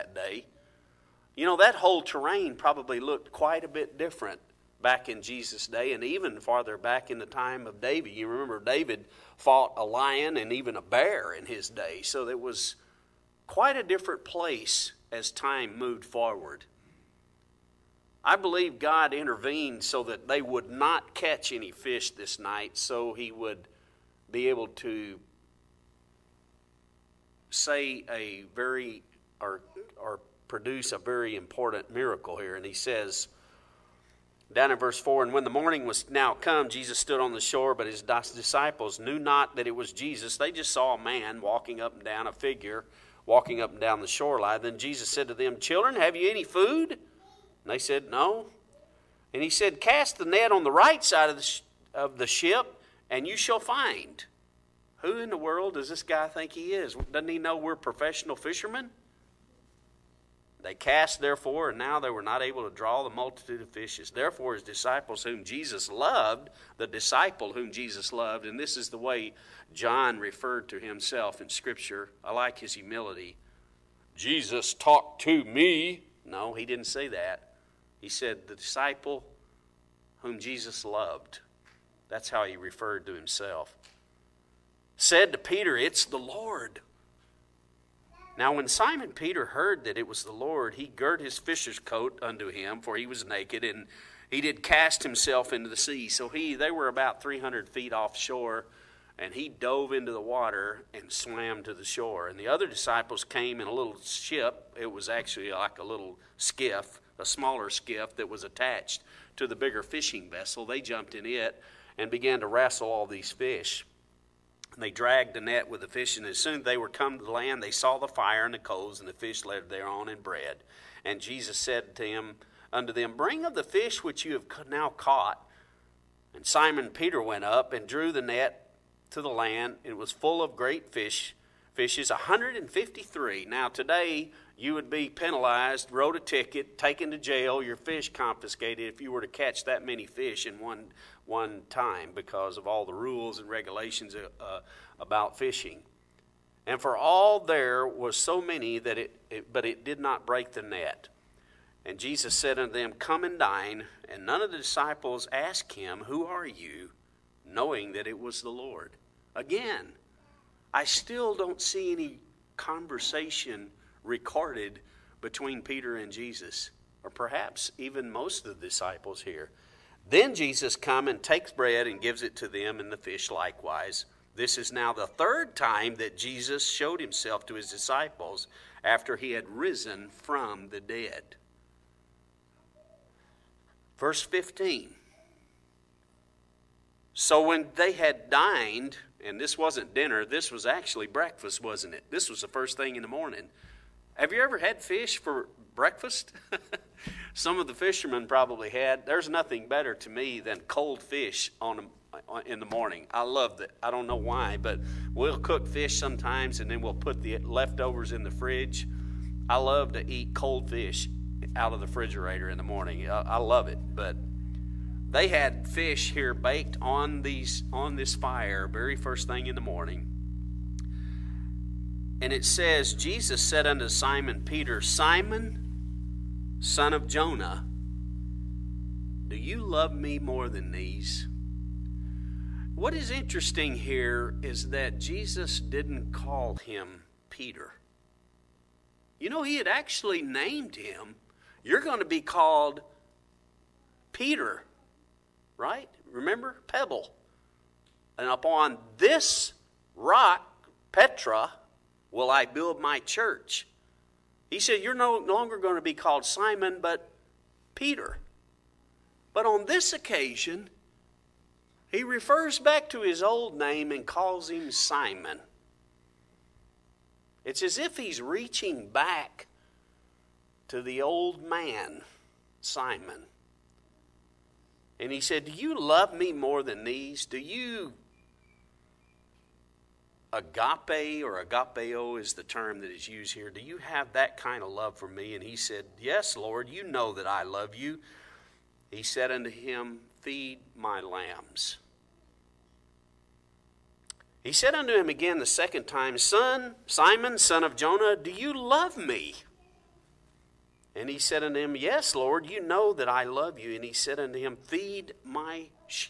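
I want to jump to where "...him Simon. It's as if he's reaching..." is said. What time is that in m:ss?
4:24.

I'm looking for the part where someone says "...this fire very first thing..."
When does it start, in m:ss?
3:37.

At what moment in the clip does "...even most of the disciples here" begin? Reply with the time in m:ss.
2:47.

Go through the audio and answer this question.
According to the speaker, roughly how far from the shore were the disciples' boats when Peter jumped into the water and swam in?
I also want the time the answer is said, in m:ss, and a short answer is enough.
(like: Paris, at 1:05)
300 feet, at 1:37.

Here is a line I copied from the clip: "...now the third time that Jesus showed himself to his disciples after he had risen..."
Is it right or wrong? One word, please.
right.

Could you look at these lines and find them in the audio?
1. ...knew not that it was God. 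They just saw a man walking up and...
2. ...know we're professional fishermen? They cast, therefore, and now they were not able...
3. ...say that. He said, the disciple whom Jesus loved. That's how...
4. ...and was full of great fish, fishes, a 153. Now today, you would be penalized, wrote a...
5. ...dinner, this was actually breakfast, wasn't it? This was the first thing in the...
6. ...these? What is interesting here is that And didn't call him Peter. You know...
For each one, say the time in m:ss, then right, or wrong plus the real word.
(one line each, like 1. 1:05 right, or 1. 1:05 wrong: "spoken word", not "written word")
1. 0:38 wrong: "Jesus", not "God"
2. 0:57 right
3. 1:16 right
4. 2:09 right
5. 3:09 right
6. 3:50 wrong: "Jesus", not "And".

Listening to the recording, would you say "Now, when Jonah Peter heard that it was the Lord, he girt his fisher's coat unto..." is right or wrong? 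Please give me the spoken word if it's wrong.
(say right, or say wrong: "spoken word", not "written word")
wrong: "Simon", not "Jonah".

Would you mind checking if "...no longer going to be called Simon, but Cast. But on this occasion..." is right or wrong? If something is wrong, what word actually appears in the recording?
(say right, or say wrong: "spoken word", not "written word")
wrong: "Peter", not "Cast".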